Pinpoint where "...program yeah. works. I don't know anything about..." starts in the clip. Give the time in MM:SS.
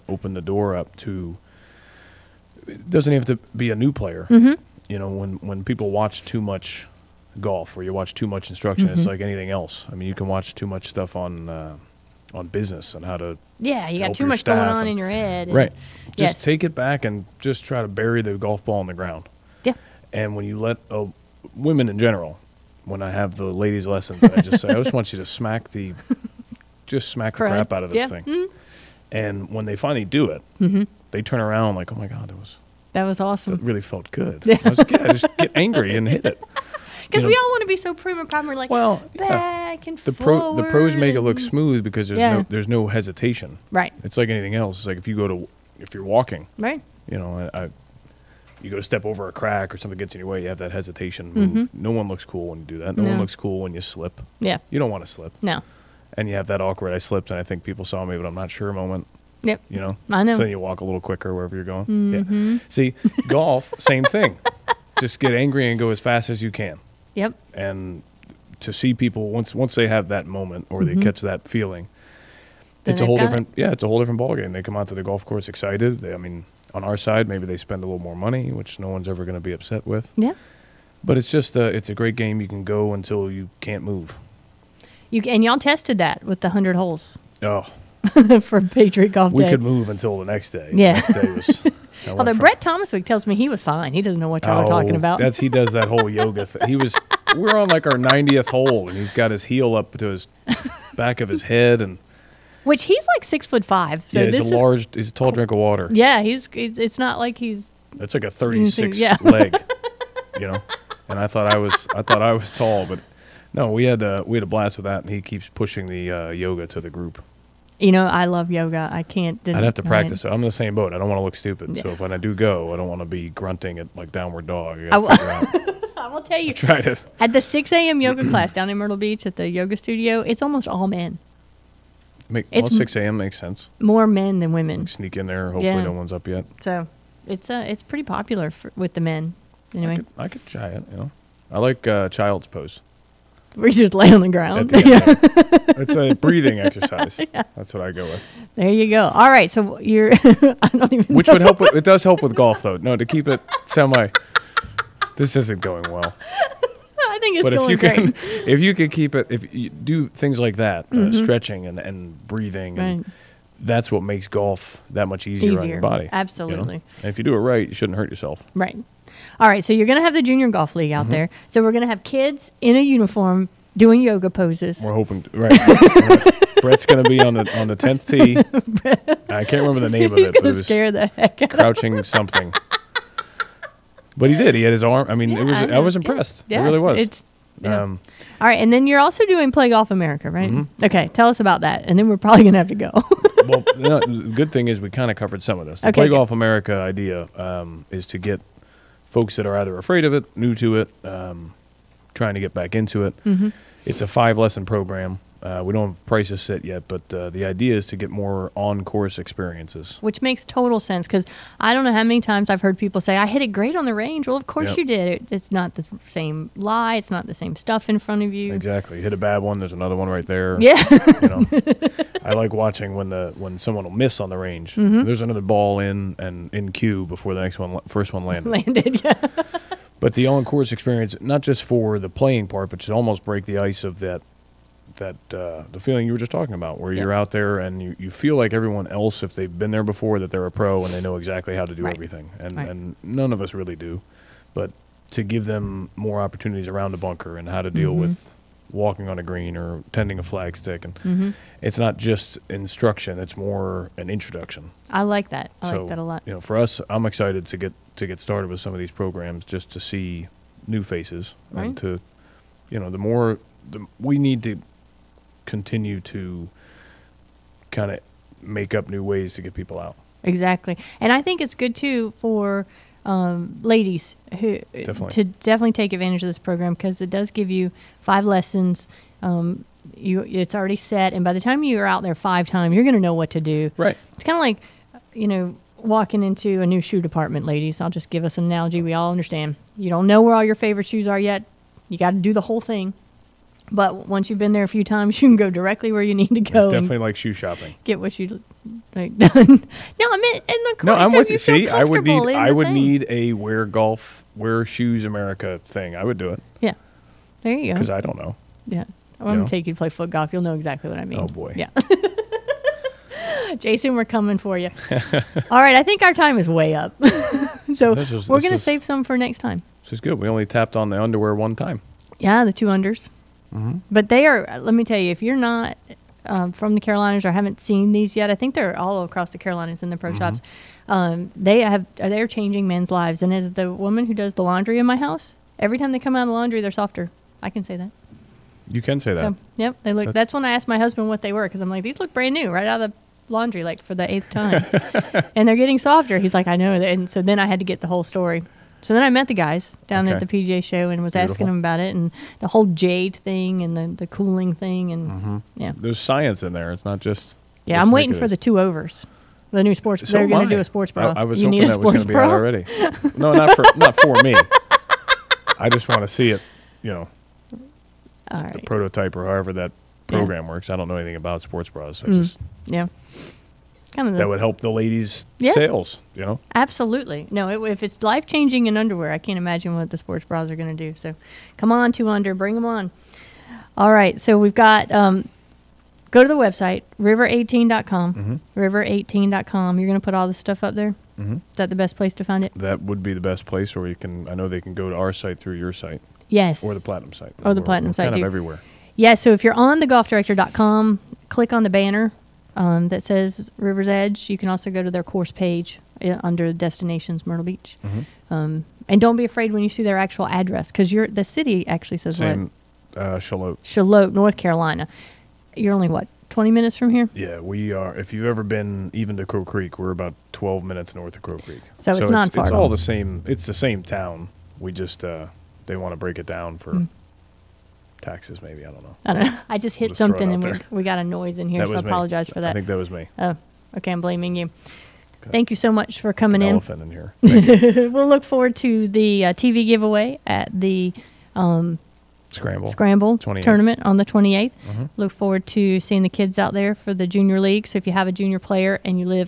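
06:10.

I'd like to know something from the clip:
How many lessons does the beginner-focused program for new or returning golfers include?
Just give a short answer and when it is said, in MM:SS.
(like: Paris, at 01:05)
5, at 03:24.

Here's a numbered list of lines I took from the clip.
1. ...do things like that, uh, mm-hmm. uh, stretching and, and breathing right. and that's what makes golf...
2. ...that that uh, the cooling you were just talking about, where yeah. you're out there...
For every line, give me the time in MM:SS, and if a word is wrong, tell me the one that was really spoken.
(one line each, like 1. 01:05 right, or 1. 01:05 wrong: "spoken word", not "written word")
1. 02:39 right
2. 03:54 wrong: "feeling", not "cooling".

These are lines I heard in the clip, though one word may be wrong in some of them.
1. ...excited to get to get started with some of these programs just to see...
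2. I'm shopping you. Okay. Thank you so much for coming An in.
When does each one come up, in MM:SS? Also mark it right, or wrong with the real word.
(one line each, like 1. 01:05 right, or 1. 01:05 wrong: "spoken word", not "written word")
1. 04:17 right
2. 07:13 wrong: "blaming", not "shopping".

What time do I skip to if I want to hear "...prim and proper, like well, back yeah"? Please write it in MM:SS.
00:37.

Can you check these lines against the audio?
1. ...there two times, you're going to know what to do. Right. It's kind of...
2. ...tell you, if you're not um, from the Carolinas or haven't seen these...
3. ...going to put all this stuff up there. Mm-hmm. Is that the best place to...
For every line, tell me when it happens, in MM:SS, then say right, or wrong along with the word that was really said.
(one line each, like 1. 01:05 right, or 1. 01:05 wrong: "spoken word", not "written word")
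1. 04:42 wrong: "five", not "two"
2. 05:24 right
3. 06:29 right.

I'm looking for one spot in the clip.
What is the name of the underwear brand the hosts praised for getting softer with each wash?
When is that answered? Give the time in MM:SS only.
06:21.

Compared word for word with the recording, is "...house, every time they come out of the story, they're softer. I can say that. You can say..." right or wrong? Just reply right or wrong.
wrong.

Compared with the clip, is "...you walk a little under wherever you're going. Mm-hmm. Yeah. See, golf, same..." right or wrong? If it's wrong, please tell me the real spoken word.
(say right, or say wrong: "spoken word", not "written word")
wrong: "quicker", not "under".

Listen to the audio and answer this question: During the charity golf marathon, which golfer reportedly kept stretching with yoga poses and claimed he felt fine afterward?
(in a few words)
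Brett Thomaswick.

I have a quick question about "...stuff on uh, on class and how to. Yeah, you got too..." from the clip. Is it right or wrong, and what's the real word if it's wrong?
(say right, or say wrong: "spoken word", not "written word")
wrong: "business", not "class".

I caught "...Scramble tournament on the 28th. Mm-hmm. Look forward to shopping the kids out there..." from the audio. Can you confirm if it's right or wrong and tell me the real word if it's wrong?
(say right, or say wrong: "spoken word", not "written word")
wrong: "seeing", not "shopping".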